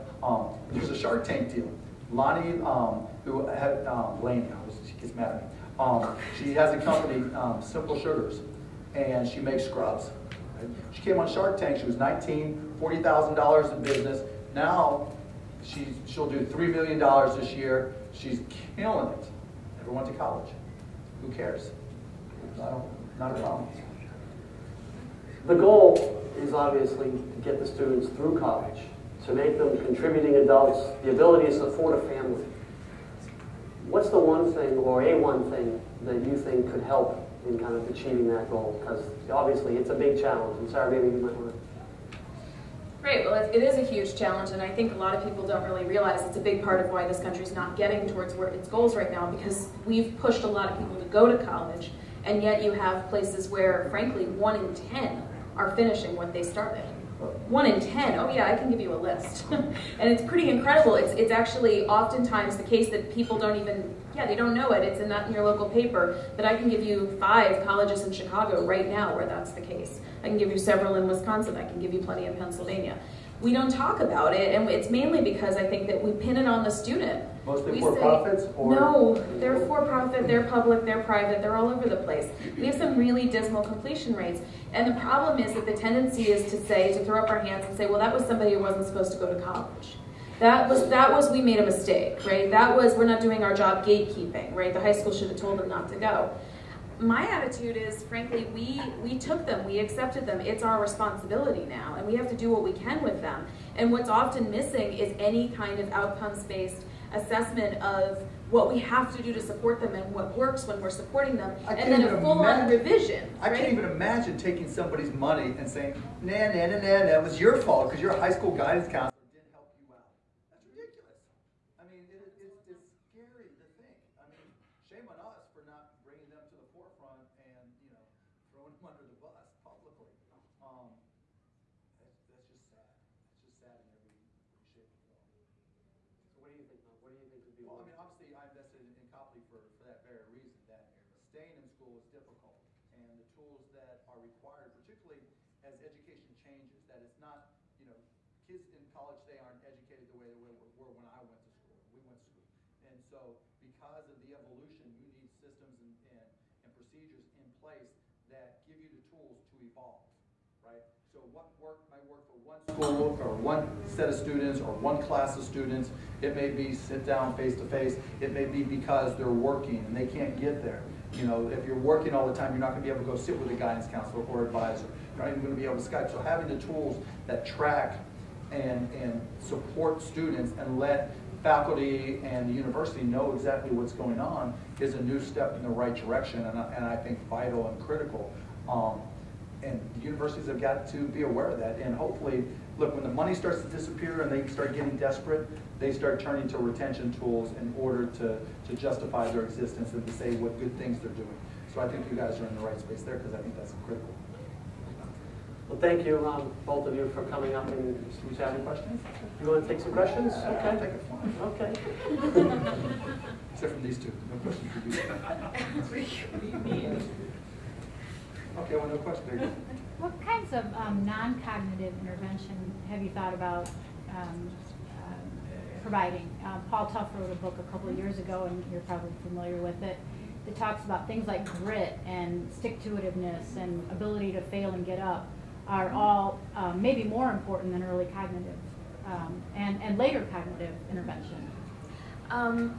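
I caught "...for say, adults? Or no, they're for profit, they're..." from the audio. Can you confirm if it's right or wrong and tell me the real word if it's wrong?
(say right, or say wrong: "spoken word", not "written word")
wrong: "profits", not "adults".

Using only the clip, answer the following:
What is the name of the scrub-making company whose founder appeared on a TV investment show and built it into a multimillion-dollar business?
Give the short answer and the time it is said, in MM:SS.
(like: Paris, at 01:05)
Simple Sugars, at 00:07.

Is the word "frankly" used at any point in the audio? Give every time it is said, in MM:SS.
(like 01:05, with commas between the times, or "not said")
00:53, 01:38.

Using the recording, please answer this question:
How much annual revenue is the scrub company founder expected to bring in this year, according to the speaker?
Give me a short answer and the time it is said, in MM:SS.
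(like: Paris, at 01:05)
$3 million, at 00:16.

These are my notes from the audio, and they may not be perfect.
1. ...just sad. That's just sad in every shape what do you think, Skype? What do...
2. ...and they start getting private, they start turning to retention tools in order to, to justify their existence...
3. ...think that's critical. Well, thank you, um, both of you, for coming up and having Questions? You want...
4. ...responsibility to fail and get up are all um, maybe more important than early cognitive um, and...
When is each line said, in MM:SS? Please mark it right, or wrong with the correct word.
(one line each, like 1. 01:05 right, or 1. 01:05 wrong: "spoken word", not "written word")
1. 02:12 wrong: "Mike", not "Skype"
2. 03:14 wrong: "desperate", not "private"
3. 03:23 right
4. 03:53 wrong: "ability", not "responsibility".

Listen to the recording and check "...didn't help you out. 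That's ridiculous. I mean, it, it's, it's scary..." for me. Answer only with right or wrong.
right.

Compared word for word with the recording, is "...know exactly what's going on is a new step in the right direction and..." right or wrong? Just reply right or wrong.
right.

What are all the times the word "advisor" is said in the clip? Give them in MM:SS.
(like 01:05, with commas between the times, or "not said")
02:54.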